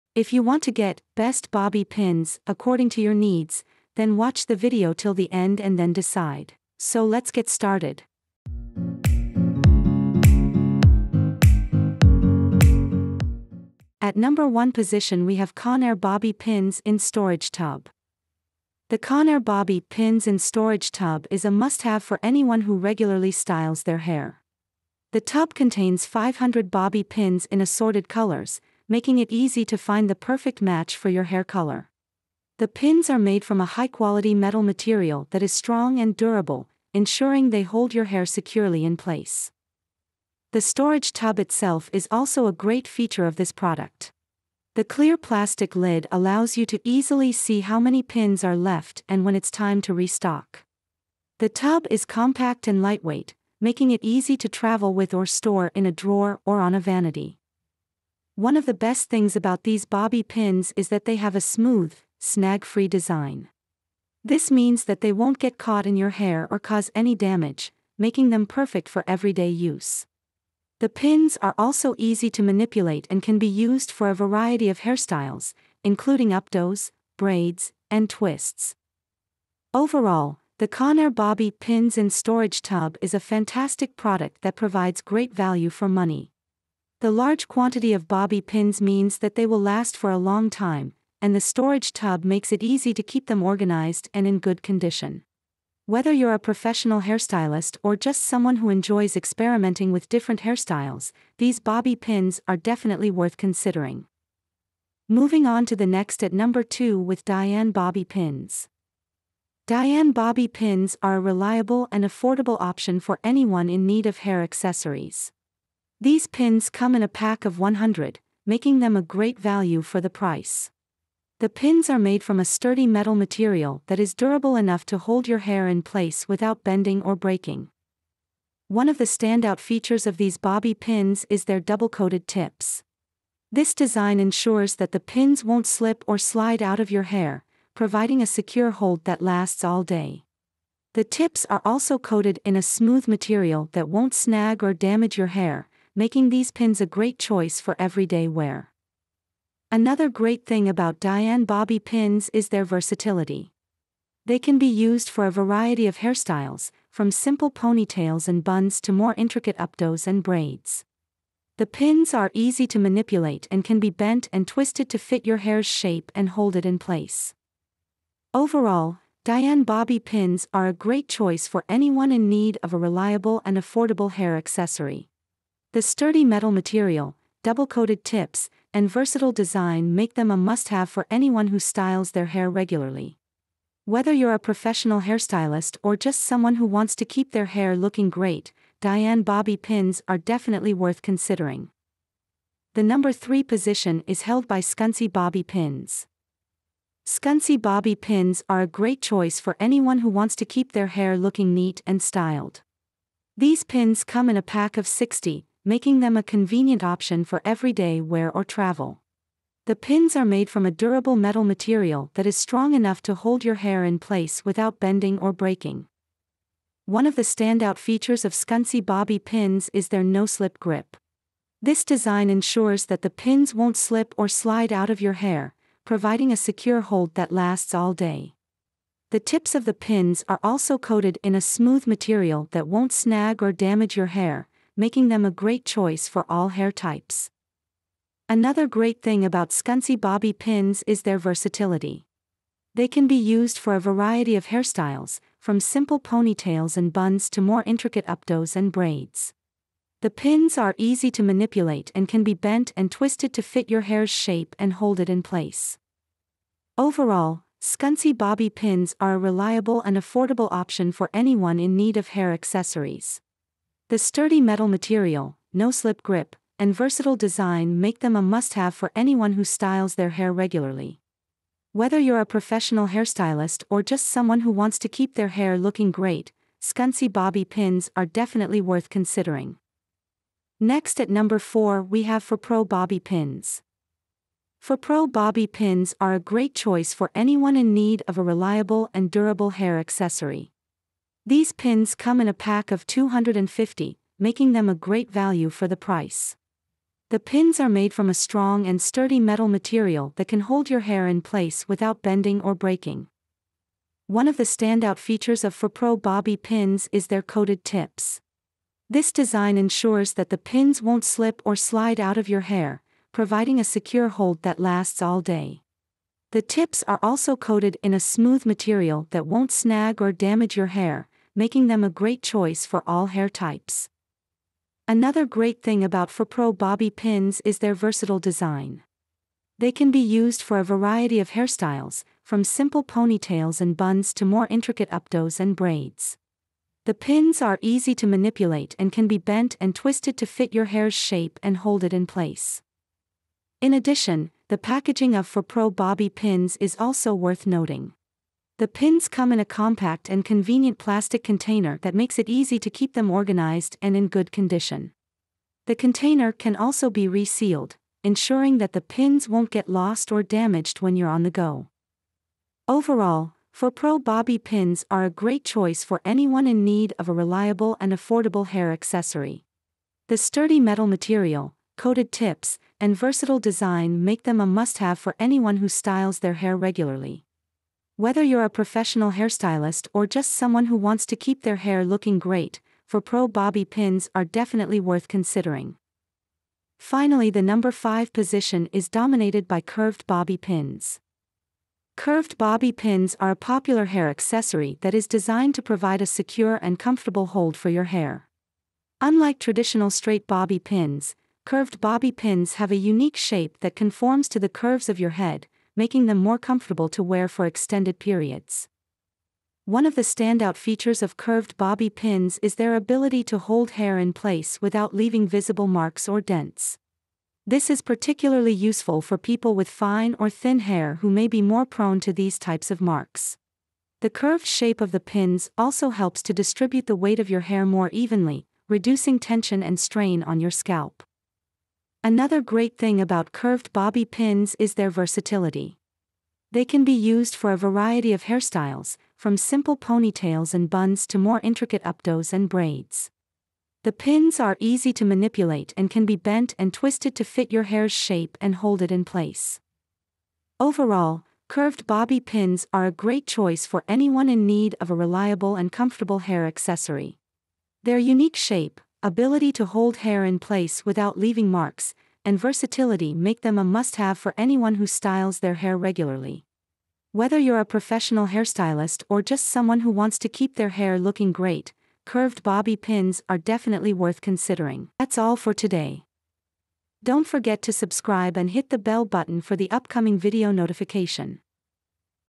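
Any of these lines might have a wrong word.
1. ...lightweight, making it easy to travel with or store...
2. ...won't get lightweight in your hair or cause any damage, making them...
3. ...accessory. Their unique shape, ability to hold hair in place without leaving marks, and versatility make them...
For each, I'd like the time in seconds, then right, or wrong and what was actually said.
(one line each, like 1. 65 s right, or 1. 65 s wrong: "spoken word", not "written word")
1. 52 s right
2. 65 s wrong: "caught", not "lightweight"
3. 456 s right.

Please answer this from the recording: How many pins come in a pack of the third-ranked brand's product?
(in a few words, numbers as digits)
60.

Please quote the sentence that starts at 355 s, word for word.
The container can also be resealed, ensuring that the pins won't get lost or damaged when you're on the go.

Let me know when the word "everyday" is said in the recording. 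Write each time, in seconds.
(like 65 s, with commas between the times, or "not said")
69 s, 147 s, 207 s.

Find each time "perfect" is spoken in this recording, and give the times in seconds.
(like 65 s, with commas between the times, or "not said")
30 s, 68 s.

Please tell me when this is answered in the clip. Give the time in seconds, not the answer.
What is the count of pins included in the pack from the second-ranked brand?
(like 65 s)
117 s.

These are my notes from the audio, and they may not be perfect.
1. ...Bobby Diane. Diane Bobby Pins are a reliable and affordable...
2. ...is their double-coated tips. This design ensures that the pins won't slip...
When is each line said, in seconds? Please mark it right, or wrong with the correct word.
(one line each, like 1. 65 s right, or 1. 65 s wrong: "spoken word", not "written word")
1. 107 s wrong: "Pins", not "Diane"
2. 131 s right.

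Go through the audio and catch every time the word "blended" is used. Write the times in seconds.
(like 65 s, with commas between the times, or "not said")
not said.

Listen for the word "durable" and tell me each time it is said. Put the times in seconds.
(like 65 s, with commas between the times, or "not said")
36 s, 124 s, 210 s, 289 s.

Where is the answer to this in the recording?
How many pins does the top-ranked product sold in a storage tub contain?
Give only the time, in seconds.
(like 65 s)
26 s.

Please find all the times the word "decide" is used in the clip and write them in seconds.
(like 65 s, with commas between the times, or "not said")
5 s.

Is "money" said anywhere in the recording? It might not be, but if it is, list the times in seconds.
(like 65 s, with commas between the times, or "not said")
85 s.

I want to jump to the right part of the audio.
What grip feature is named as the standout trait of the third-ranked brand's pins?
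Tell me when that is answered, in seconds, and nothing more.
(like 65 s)
220 s.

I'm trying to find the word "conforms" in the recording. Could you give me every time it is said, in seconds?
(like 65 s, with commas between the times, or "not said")
403 s.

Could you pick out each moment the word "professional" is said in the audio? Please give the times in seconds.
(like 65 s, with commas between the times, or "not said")
96 s, 184 s, 272 s, 378 s, 467 s.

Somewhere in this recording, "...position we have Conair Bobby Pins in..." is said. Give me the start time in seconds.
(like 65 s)
14 s.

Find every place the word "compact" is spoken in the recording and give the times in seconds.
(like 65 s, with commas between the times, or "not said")
52 s, 349 s.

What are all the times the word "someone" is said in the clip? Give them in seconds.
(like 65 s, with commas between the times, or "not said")
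98 s, 186 s, 274 s, 380 s, 469 s.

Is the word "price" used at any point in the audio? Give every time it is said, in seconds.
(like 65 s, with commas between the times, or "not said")
120 s, 295 s.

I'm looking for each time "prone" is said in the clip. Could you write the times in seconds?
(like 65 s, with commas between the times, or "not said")
421 s.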